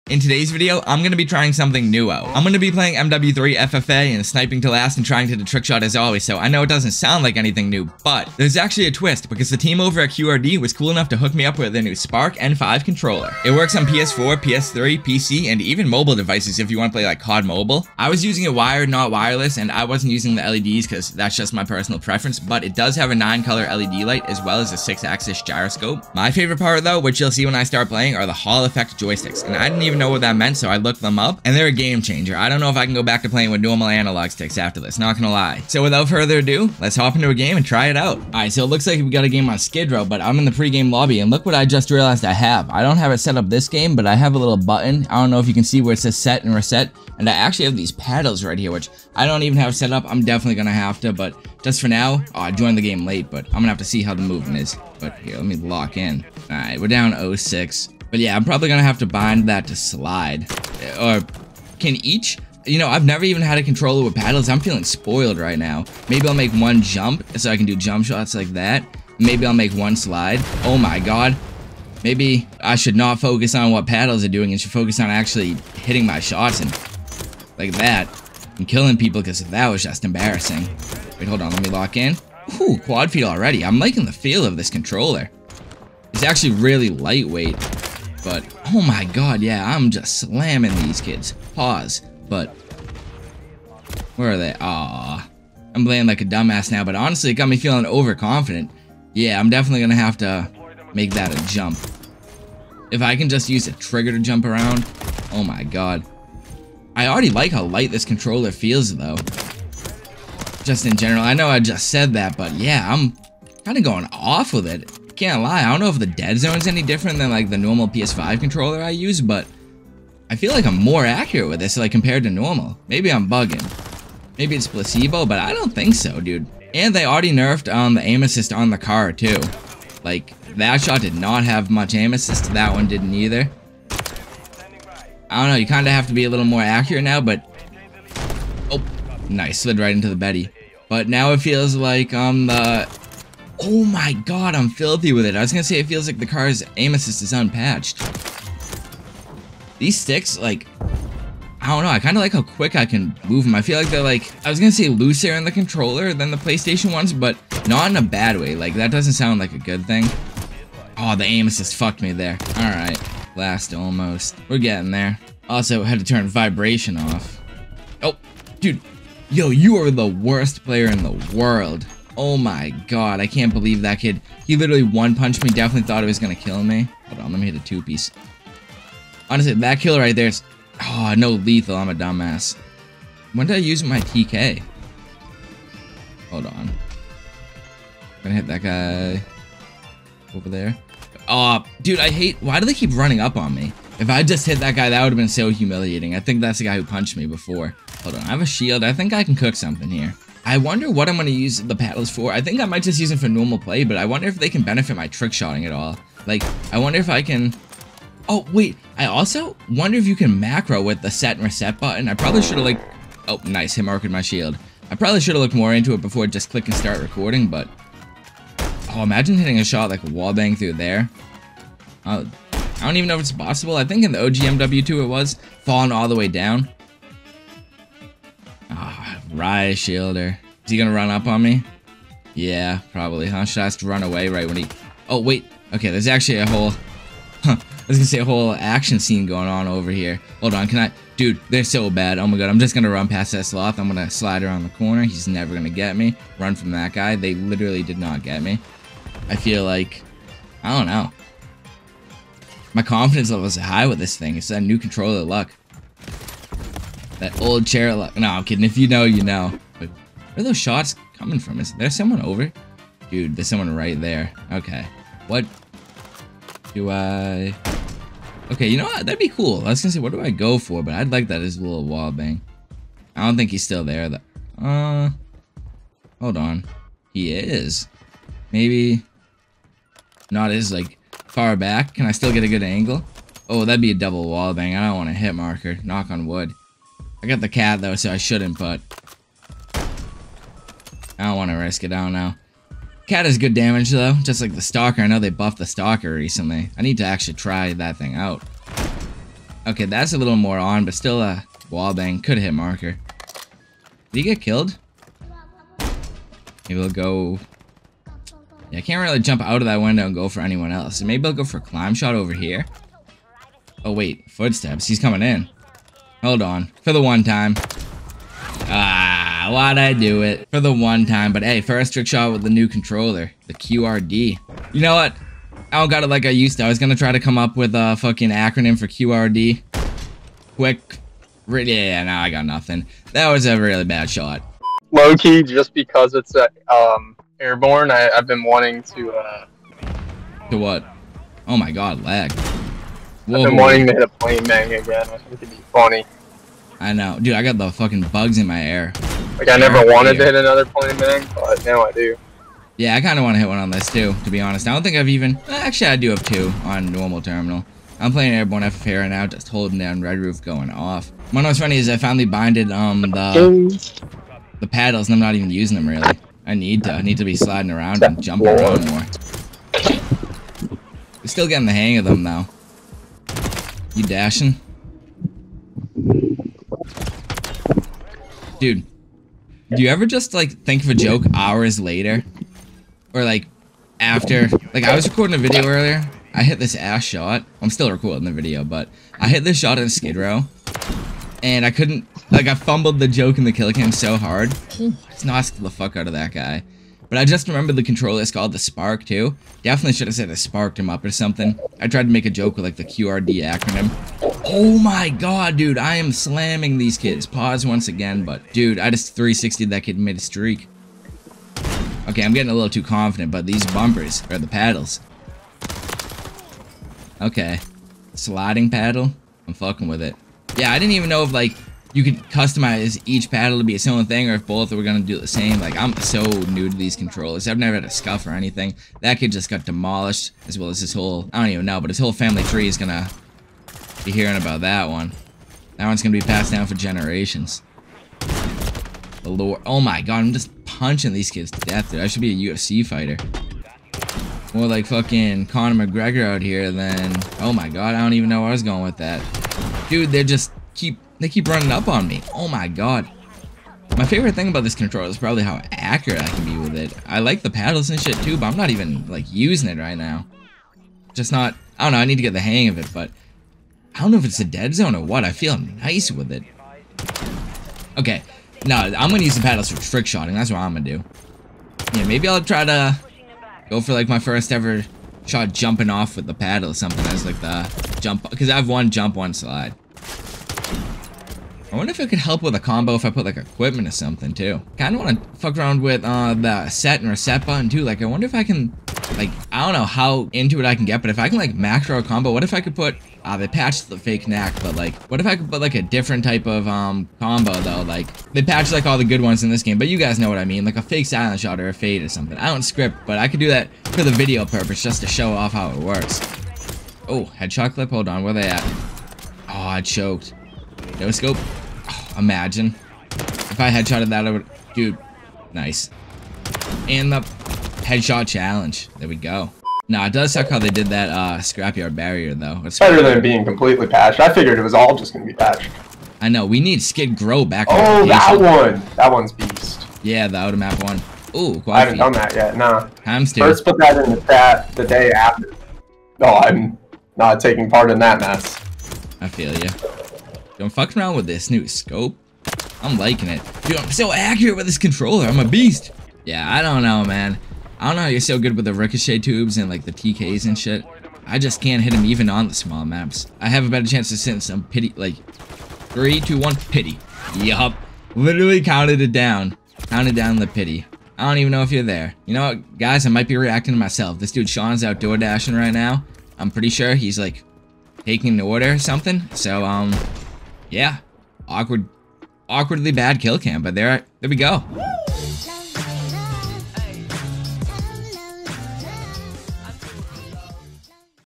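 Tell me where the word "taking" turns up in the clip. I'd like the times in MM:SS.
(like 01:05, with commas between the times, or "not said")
08:57, 09:28.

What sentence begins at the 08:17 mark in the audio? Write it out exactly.
Like, they patched like all the good ones in this game, but you guys know what I mean.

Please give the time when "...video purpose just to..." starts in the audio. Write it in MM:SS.
08:24.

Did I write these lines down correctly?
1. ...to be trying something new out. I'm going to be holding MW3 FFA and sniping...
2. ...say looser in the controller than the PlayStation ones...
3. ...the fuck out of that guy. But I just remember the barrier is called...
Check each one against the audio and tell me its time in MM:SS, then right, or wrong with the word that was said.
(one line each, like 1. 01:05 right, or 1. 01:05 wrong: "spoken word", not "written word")
1. 00:01 wrong: "playing", not "holding"
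2. 02:34 right
3. 06:35 wrong: "controller", not "barrier".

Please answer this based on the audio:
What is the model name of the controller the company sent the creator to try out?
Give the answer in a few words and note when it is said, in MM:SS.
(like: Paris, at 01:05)
Spark N5, at 00:11.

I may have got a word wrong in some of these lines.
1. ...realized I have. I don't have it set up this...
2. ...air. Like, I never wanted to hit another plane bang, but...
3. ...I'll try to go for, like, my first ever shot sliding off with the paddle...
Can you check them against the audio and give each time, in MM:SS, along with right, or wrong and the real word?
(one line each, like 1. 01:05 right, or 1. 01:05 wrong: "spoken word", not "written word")
1. 00:41 right
2. 05:48 right
3. 07:52 wrong: "jumping", not "sliding".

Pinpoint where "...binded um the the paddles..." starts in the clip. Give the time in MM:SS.
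06:02.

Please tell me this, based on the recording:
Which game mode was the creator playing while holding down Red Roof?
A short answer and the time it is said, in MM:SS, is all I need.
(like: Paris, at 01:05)
Airborne FFA, at 05:58.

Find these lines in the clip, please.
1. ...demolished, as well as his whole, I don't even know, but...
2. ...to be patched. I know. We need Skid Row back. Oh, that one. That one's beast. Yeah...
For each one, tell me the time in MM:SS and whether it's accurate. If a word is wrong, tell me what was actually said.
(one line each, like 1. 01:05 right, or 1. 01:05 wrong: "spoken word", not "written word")
1. 07:09 right
2. 08:45 right.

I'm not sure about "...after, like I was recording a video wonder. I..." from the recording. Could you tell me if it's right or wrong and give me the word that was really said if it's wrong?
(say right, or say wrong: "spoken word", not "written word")
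wrong: "earlier", not "wonder".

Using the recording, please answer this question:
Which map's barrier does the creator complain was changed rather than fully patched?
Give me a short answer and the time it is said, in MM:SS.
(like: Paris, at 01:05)
Scrapyard, at 08:41.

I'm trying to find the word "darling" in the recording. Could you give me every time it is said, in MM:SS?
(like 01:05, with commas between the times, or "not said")
not said.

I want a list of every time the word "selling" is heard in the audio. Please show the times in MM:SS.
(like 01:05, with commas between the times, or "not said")
not said.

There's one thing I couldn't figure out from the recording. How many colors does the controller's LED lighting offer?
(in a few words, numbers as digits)
9.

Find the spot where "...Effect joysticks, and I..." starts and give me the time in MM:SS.
00:28.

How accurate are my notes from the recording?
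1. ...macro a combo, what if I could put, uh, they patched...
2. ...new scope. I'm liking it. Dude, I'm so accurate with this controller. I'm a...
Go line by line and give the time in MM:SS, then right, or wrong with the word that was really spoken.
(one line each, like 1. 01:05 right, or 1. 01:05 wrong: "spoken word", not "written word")
1. 08:11 right
2. 09:01 right.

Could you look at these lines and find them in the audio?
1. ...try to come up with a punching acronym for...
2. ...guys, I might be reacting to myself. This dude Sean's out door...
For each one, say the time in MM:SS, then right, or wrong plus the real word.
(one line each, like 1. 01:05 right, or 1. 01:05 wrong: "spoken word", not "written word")
1. 05:26 wrong: "fucking", not "punching"
2. 09:22 right.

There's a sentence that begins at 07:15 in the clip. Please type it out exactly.
That one's gonna be passed down for generations.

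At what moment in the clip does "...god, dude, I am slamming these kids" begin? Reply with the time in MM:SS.
06:45.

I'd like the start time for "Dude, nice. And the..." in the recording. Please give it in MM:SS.
08:34.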